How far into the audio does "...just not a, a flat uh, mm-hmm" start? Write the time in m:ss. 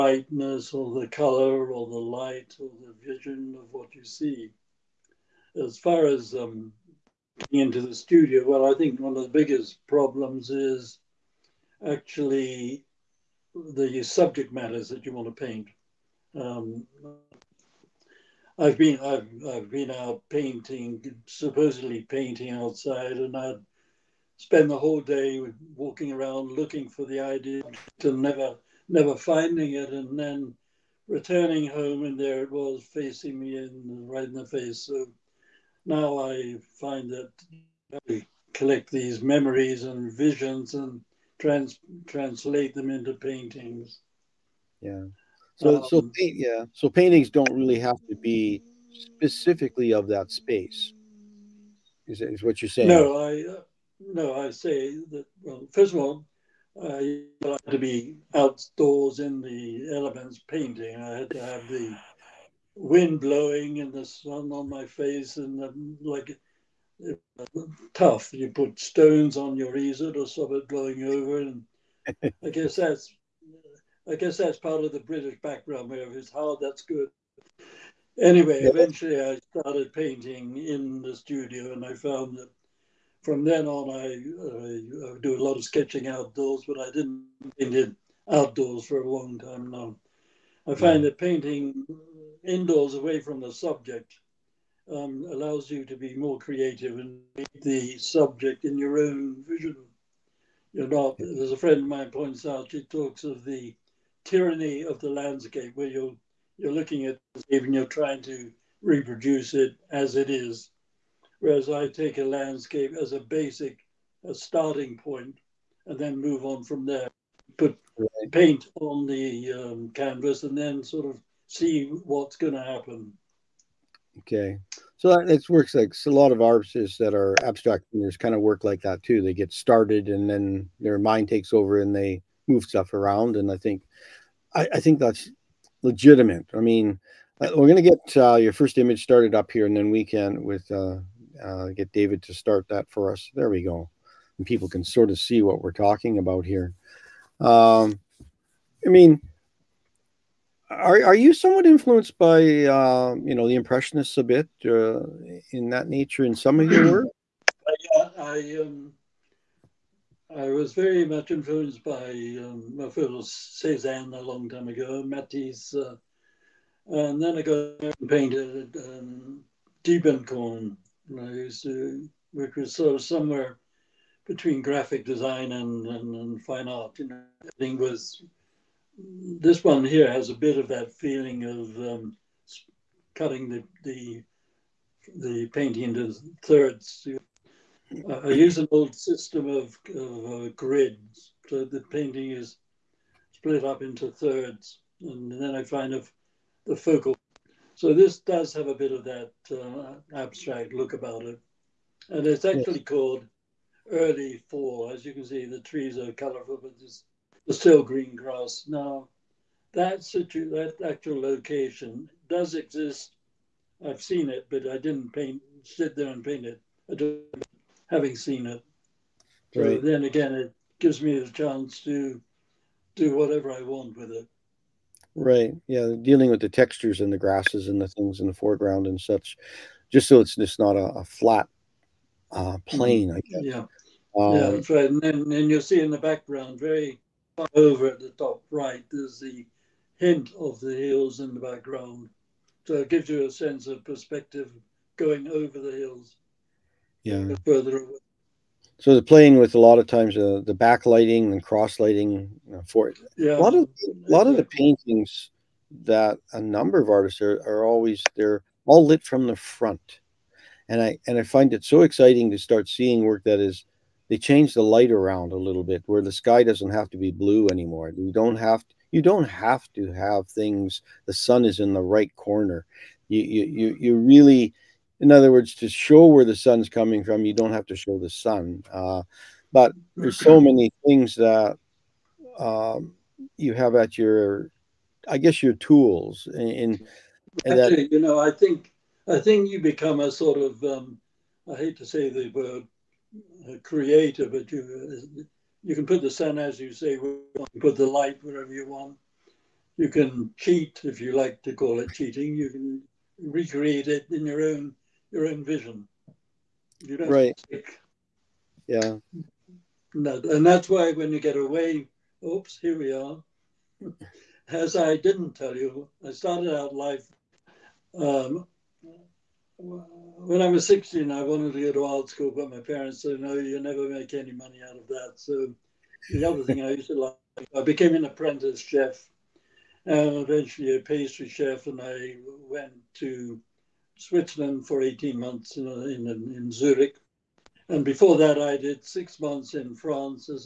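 3:50.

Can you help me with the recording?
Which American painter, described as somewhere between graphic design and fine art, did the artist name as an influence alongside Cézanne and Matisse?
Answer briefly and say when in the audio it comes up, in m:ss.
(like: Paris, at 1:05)
Diebenkorn, at 2:49.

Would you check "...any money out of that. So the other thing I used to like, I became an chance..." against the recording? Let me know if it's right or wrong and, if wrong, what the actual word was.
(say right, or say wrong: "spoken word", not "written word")
wrong: "apprentice", not "chance".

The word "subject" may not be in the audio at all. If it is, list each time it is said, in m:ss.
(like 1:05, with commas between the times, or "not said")
0:14, 1:33, 1:37.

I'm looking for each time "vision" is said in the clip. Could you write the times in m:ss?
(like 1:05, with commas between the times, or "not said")
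0:03, 0:40, 1:39, 5:05.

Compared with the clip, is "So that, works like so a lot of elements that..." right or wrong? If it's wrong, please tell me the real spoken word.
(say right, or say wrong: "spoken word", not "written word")
wrong: "artists", not "elements".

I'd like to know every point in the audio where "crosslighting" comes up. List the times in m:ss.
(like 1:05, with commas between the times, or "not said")
4:11.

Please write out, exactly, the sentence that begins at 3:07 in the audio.
You I use an old system of, of uh, grids.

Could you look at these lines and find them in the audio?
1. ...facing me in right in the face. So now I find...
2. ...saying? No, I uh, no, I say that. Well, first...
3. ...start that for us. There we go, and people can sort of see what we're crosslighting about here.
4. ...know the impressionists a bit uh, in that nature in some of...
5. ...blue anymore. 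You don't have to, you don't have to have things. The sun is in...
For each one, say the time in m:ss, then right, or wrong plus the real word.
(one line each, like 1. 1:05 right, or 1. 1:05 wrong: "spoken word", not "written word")
1. 0:32 right
2. 0:52 right
3. 2:22 wrong: "talking", not "crosslighting"
4. 2:33 right
5. 4:27 right.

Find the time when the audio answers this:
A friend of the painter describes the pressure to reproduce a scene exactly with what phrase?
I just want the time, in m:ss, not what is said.
1:44.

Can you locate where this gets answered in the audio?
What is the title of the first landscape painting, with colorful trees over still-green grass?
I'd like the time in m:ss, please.
3:23.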